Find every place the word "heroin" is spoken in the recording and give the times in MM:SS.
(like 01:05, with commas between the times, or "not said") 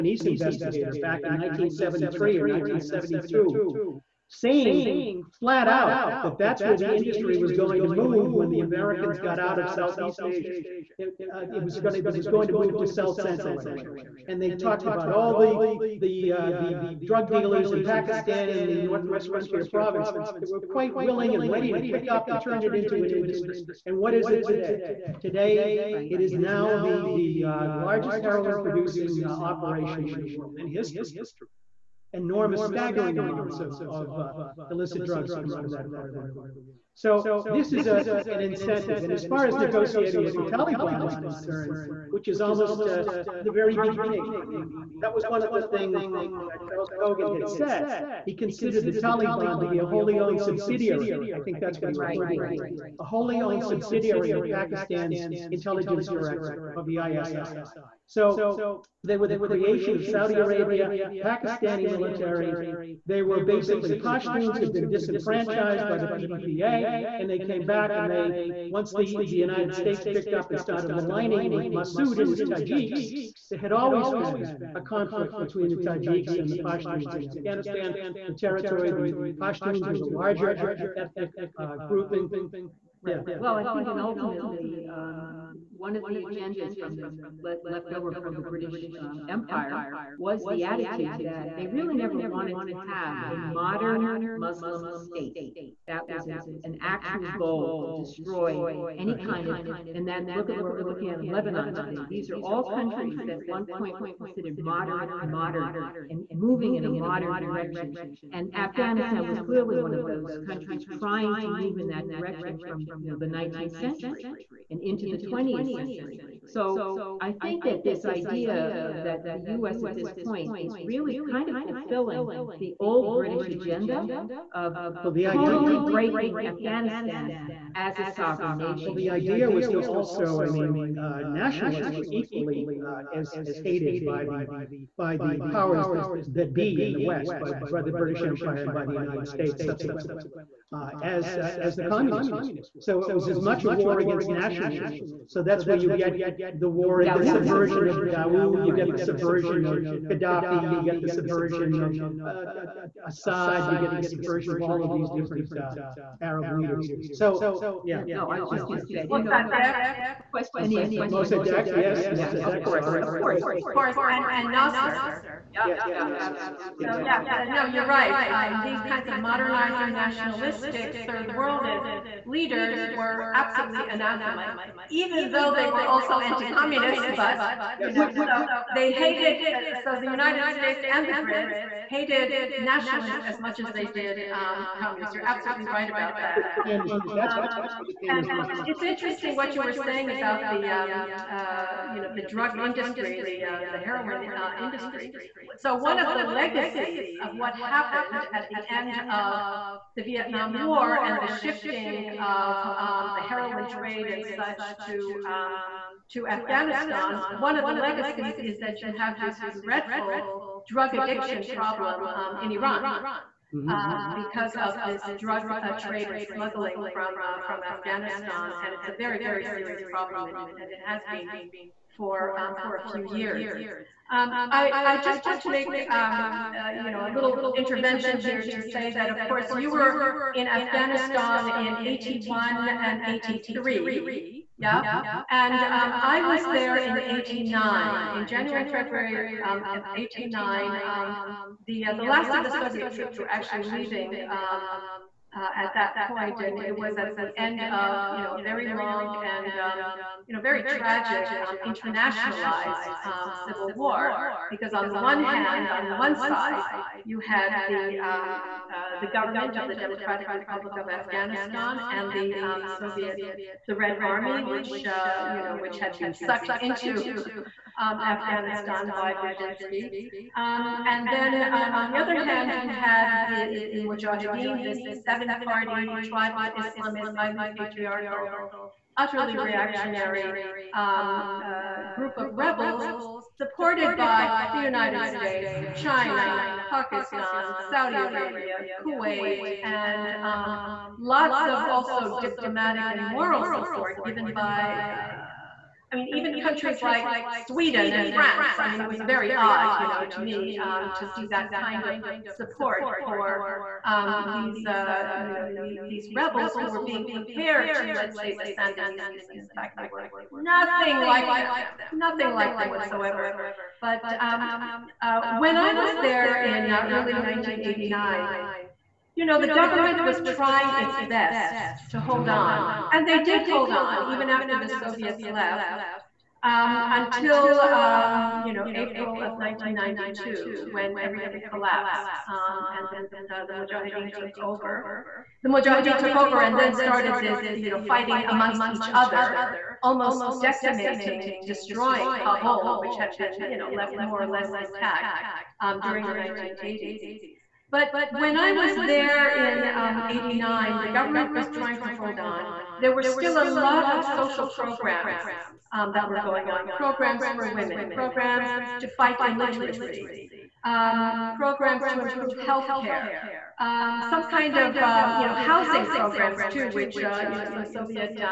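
00:28, 03:13, 03:23.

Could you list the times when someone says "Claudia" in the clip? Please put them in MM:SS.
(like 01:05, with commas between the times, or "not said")
not said.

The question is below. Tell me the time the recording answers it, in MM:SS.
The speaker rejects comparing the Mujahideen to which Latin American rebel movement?
05:08.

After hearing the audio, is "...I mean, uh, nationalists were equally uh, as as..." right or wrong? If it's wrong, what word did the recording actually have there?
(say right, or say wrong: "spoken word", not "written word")
right.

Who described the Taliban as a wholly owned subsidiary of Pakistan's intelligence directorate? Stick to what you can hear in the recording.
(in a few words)
Charles Cogan.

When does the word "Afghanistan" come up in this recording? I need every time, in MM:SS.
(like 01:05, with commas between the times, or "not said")
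01:17, 01:48, 02:06, 03:26, 03:37, 03:50, 04:20, 04:28.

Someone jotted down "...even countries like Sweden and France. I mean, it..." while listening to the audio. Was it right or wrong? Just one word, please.
right.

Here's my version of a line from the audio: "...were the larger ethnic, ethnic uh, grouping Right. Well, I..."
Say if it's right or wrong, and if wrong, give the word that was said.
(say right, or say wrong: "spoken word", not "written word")
right.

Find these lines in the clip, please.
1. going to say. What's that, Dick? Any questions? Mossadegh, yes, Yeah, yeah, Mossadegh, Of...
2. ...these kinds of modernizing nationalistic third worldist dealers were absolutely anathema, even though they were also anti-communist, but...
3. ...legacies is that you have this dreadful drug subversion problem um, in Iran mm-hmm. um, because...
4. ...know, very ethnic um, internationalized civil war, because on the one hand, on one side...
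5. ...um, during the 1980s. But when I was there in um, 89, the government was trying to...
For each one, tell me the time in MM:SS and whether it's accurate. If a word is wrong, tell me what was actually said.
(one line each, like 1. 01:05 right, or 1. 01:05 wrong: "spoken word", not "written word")
1. 02:38 right
2. 02:48 wrong: "leaders", not "dealers"
3. 03:27 wrong: "addiction", not "subversion"
4. 04:10 wrong: "tragic", not "ethnic"
5. 05:45 right.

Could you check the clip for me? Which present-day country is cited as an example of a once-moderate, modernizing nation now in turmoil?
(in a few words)
Lebanon.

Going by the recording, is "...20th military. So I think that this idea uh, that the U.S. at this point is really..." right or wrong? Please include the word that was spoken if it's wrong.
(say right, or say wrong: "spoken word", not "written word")
wrong: "century", not "military".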